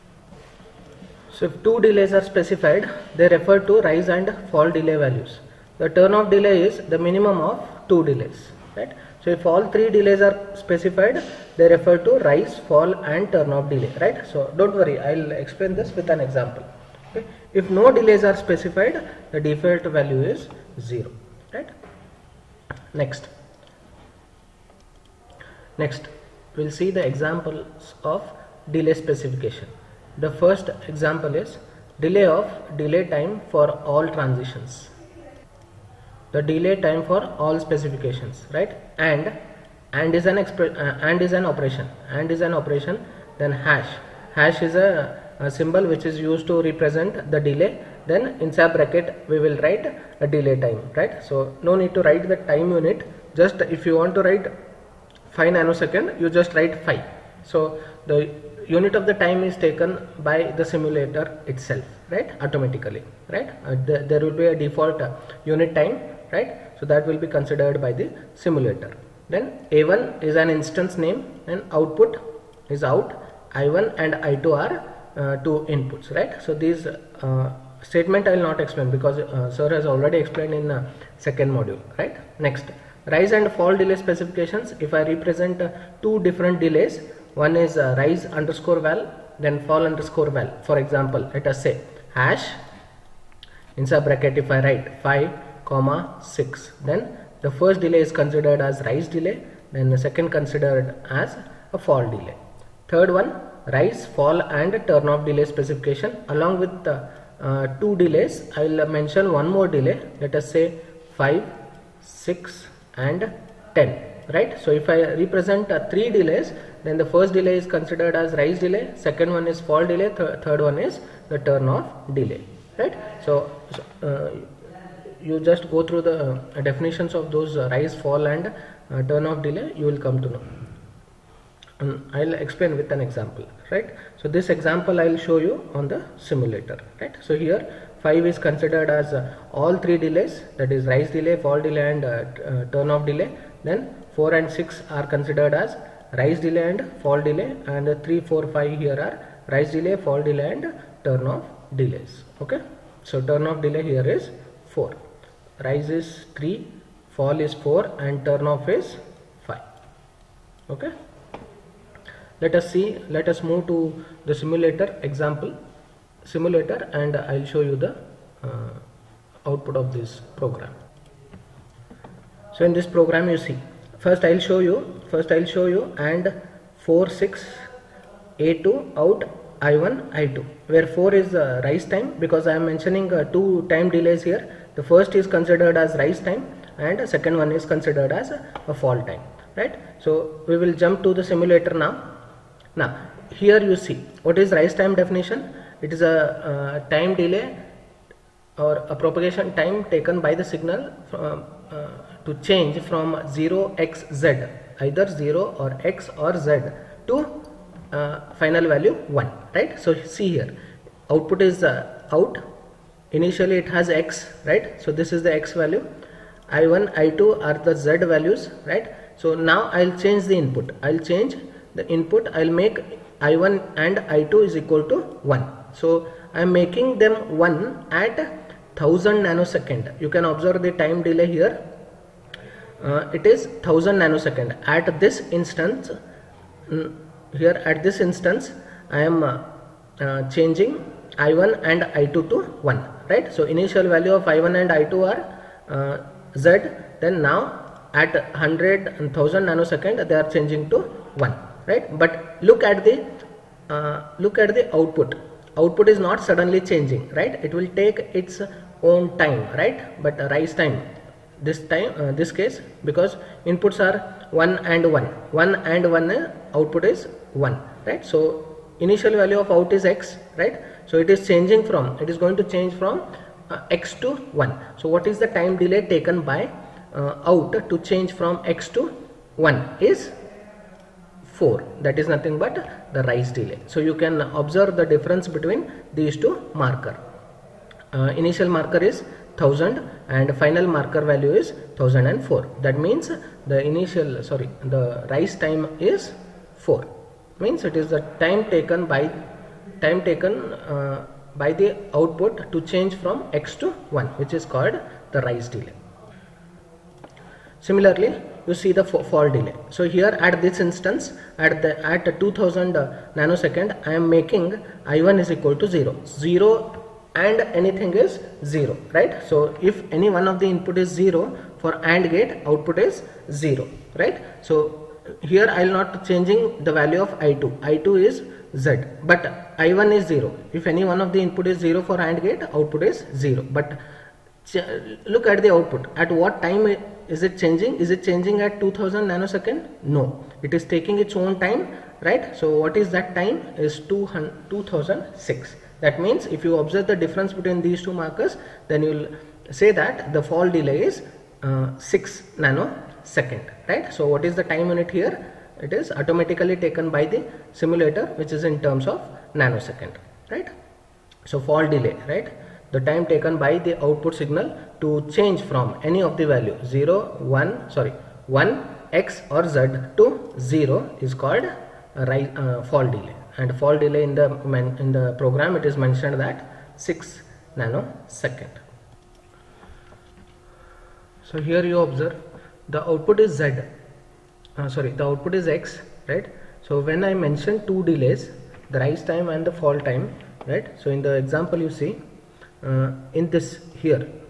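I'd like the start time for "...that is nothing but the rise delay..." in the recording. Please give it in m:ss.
4:41.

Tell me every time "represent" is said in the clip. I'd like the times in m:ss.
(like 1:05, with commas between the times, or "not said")
0:46, 1:25, 1:55.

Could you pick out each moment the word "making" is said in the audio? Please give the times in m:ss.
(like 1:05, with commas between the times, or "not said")
3:46, 5:14.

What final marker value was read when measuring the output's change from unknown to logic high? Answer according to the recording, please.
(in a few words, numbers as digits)
1004.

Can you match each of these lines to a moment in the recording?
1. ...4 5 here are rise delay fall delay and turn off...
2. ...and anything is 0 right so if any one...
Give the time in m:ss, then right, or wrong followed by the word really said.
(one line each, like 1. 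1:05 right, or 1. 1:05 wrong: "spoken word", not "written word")
1. 2:28 right
2. 5:17 right.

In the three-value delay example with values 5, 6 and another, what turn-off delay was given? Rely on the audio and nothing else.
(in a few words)
10.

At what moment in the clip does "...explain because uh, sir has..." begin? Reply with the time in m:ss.
1:18.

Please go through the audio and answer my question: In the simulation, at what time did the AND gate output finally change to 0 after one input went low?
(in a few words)
2006.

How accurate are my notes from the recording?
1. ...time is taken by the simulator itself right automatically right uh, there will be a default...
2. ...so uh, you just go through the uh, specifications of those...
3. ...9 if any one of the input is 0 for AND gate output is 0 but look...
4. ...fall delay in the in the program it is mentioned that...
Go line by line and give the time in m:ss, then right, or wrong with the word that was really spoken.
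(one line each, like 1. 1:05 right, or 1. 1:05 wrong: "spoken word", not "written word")
1. 0:59 right
2. 2:03 wrong: "definitions", not "specifications"
3. 5:30 wrong: "0", not "9"
4. 6:13 right.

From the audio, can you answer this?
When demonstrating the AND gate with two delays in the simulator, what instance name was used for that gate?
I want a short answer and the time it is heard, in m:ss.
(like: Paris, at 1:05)
a2, at 2:58.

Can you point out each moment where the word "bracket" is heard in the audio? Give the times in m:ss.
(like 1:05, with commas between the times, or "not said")
0:48, 1:34.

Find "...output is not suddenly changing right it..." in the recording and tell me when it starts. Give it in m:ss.
4:15.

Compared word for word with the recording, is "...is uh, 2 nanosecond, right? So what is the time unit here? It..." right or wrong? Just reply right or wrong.
wrong.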